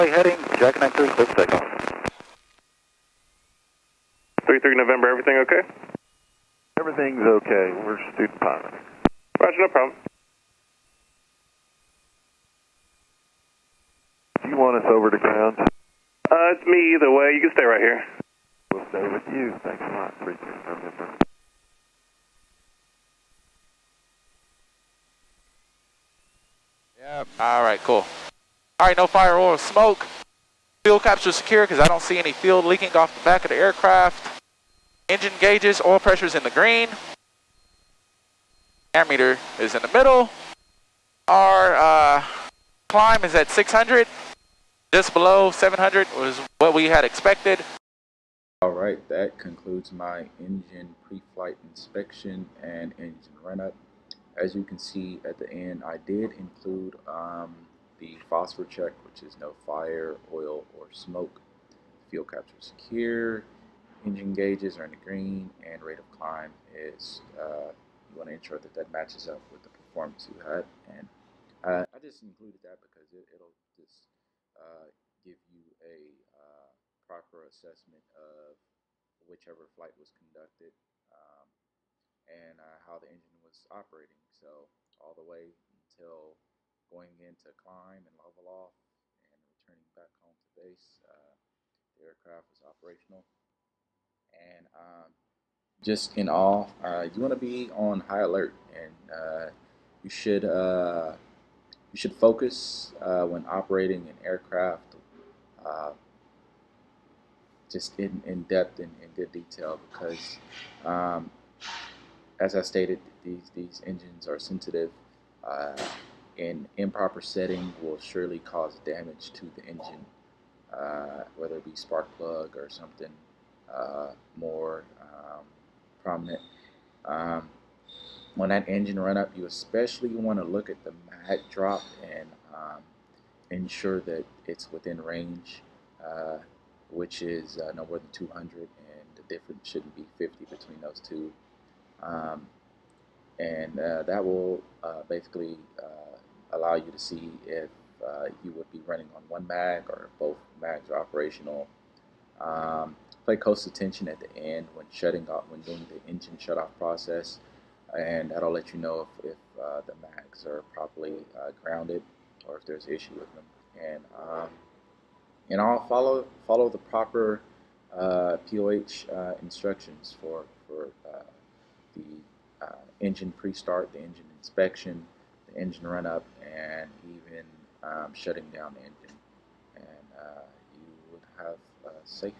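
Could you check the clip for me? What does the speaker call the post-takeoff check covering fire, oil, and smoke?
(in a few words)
phosphor check.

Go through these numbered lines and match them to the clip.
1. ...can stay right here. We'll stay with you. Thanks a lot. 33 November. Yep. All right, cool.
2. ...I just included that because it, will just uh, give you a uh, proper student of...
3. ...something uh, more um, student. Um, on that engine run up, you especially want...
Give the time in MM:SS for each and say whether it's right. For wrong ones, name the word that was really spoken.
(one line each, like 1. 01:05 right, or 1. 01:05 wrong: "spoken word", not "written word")
1. 00:17 right
2. 01:11 wrong: "assessment", not "student"
3. 02:02 wrong: "prominent", not "student".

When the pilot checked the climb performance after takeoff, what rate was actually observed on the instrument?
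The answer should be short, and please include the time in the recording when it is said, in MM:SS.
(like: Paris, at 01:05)
600, at 00:43.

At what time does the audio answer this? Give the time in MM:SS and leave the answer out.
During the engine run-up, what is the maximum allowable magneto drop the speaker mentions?
02:17.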